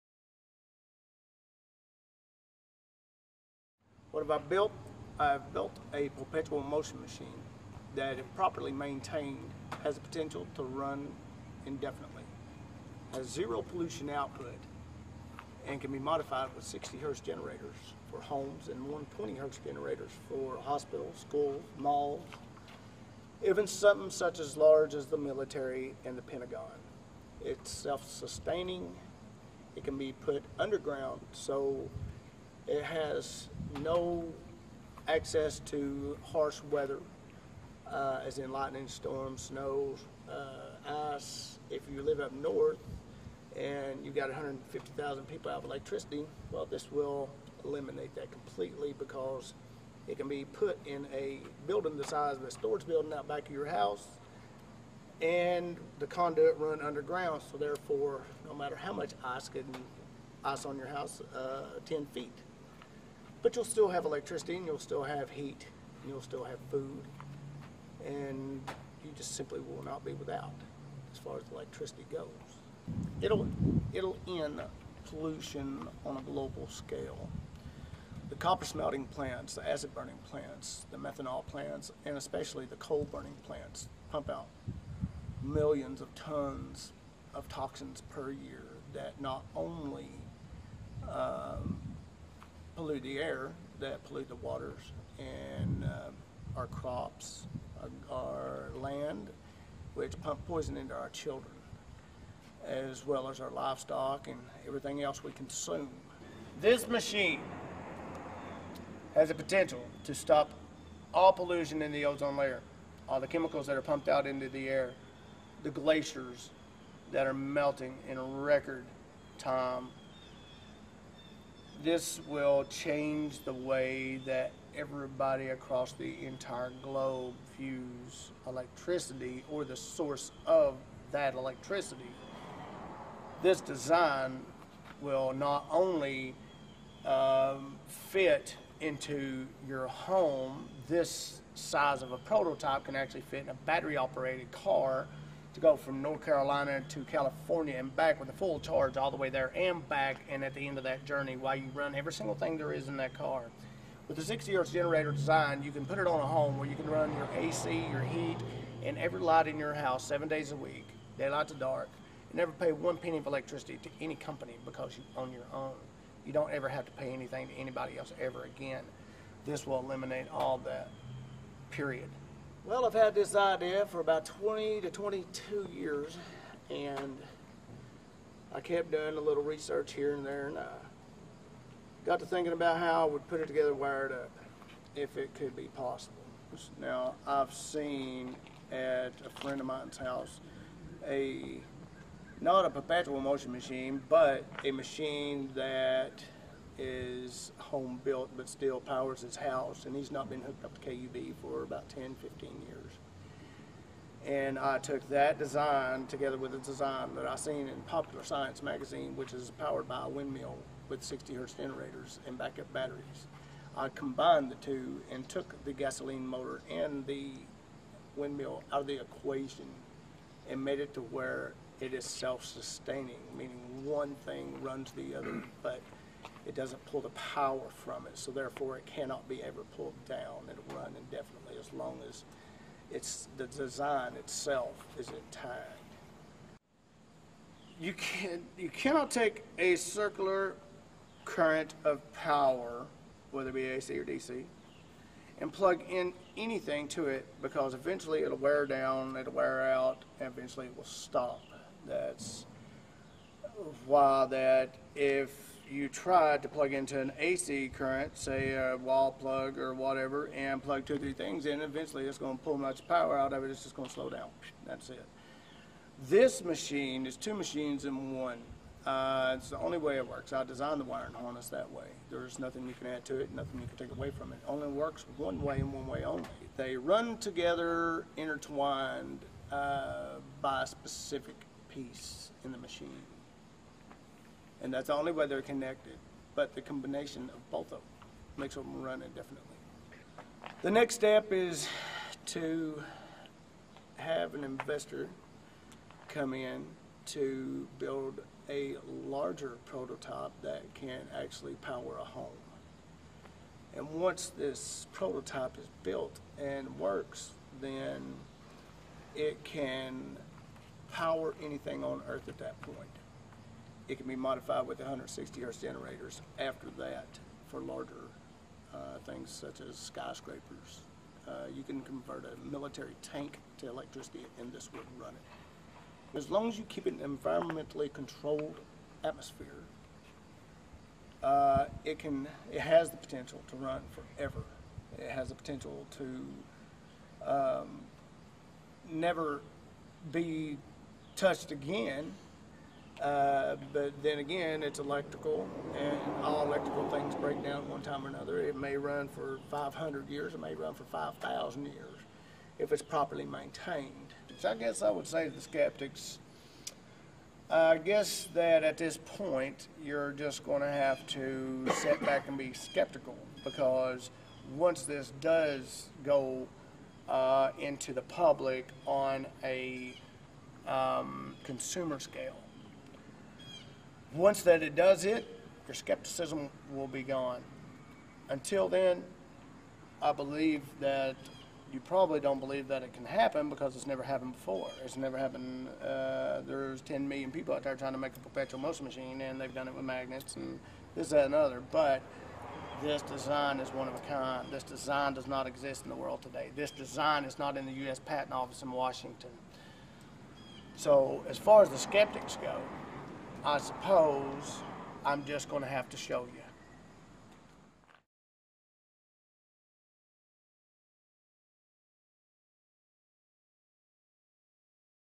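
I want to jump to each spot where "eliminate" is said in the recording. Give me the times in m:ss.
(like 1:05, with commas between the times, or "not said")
0:47, 2:49.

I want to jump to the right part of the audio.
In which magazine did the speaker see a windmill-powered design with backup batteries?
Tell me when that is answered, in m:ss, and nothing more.
3:27.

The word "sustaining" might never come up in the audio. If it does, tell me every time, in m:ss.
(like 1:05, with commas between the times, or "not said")
0:27, 3:42.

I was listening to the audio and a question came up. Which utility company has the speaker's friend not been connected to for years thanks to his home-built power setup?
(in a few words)
KUB.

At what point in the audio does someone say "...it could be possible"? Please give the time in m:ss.
3:05.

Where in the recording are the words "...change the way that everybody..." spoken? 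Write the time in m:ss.
2:02.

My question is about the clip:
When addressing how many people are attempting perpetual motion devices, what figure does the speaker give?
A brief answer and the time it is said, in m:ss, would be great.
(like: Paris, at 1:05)
10 million, at 6:26.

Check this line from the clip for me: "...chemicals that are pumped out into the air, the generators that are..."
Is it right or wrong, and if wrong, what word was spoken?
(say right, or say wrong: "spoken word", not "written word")
wrong: "glaciers", not "generators".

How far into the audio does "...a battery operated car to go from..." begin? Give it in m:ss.
2:23.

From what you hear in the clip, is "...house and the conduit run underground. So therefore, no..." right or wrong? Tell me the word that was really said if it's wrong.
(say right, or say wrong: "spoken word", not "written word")
right.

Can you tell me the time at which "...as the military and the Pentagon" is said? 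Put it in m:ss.
0:24.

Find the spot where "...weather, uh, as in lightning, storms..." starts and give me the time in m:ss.
0:36.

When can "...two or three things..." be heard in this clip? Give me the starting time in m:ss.
4:20.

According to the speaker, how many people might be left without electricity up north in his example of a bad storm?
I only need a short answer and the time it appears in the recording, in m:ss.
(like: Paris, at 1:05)
150,000, at 0:44.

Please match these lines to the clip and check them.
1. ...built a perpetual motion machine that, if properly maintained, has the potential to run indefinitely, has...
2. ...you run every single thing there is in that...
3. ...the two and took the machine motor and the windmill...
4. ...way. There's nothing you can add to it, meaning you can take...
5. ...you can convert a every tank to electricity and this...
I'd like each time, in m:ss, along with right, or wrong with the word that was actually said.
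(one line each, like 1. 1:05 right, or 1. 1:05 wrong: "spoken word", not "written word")
1. 0:05 right
2. 2:31 right
3. 3:34 wrong: "gasoline", not "machine"
4. 4:31 wrong: "nothing", not "meaning"
5. 5:21 wrong: "military", not "every".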